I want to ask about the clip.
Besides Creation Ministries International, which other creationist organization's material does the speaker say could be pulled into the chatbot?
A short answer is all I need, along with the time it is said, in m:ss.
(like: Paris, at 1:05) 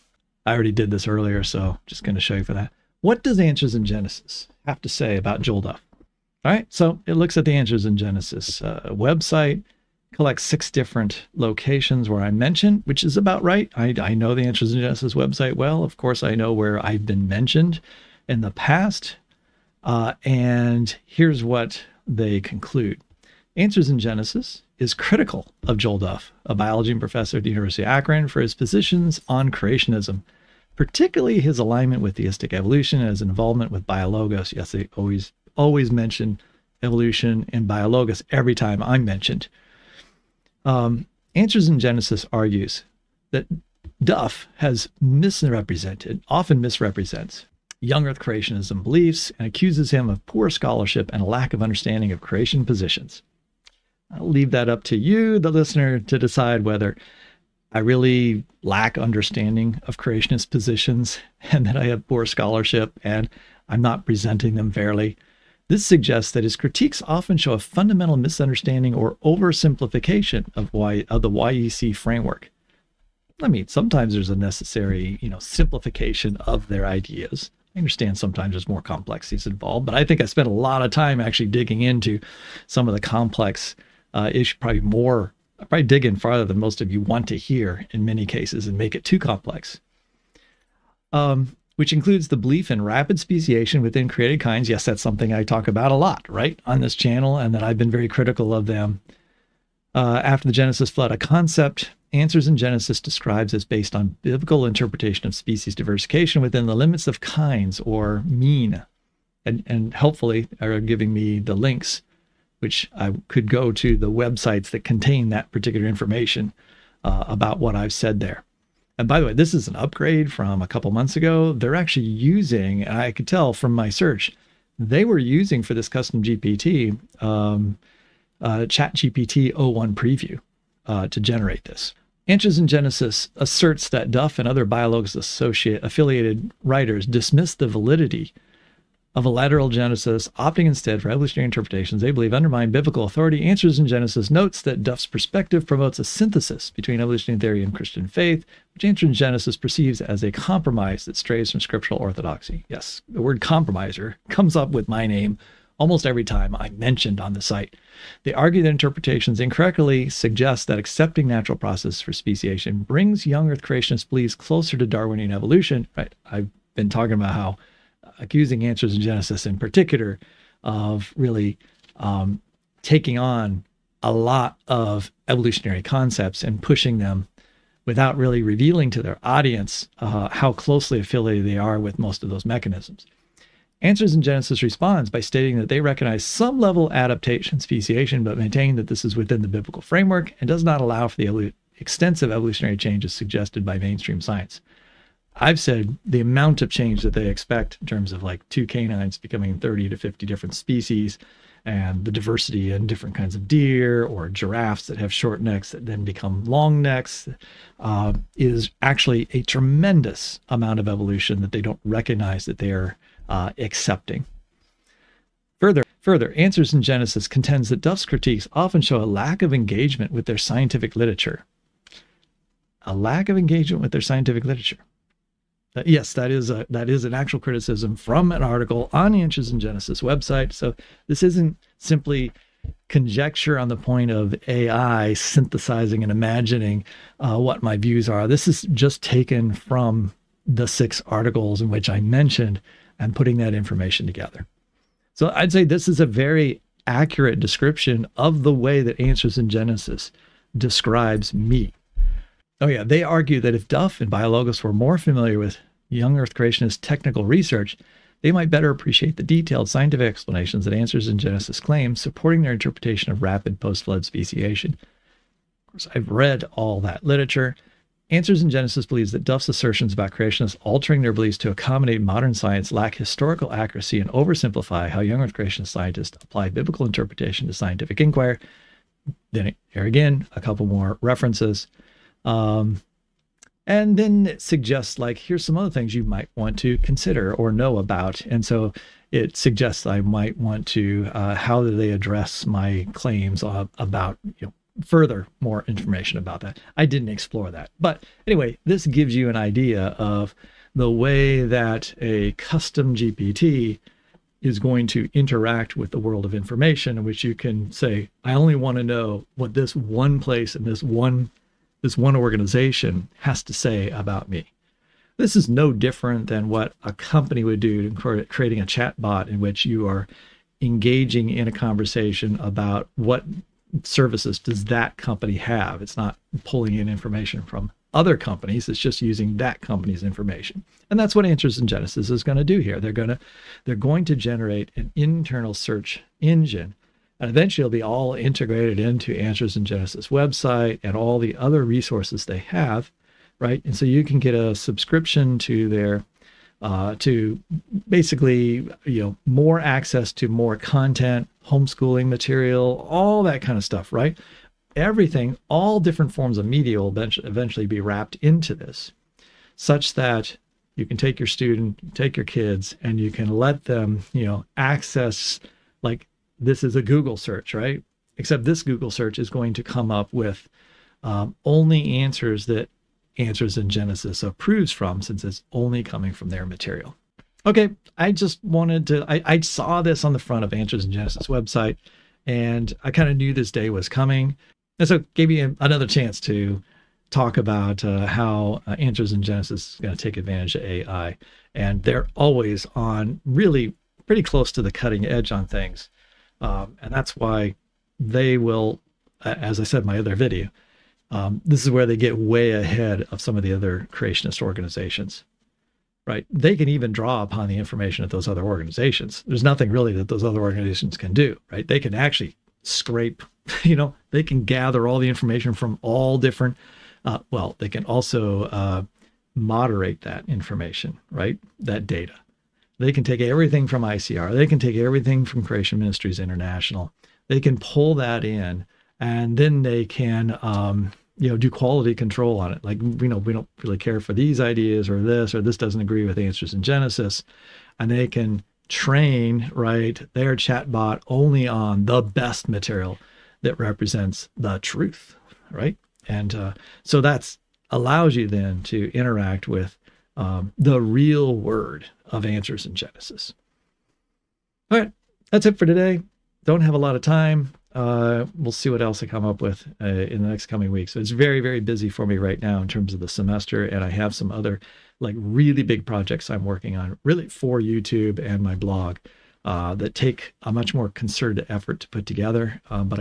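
ICR, at 7:03.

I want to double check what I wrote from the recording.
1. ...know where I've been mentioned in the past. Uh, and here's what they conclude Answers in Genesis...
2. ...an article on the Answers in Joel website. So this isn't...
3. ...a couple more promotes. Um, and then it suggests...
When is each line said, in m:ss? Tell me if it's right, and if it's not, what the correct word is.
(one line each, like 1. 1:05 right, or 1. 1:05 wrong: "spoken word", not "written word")
1. 0:16 right
2. 3:48 wrong: "Genesis", not "Joel"
3. 4:40 wrong: "references", not "promotes".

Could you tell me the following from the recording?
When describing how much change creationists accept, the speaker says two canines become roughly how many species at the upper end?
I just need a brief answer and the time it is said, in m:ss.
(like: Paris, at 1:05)
50, at 3:19.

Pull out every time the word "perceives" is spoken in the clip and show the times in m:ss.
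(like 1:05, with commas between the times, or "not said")
2:29.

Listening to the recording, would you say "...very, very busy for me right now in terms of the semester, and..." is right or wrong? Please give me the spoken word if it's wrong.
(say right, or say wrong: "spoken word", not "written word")
right.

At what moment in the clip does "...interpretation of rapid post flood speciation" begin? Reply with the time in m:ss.
4:22.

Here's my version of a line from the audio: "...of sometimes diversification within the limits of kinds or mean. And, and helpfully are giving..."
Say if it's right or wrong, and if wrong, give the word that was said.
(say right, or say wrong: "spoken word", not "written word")
wrong: "species", not "sometimes".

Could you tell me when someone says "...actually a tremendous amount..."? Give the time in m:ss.
3:28.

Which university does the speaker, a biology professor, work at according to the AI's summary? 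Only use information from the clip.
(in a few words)
University of Akron.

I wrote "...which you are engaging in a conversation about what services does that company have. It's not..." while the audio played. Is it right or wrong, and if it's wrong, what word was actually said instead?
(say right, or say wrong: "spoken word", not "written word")
right.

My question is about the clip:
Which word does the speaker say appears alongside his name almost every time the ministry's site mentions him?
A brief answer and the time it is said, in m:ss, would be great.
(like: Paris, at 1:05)
compromiser, at 2:33.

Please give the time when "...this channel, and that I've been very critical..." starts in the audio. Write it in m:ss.
1:36.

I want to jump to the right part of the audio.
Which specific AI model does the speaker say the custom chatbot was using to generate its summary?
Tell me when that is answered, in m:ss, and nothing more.
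2:08.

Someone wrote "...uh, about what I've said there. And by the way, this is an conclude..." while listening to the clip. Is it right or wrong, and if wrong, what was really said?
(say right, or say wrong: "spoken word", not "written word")
wrong: "upgrade", not "conclude".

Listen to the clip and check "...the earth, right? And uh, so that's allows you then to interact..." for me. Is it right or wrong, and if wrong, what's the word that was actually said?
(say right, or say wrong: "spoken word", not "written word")
wrong: "truth", not "earth".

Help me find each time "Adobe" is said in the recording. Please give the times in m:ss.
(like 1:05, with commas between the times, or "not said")
not said.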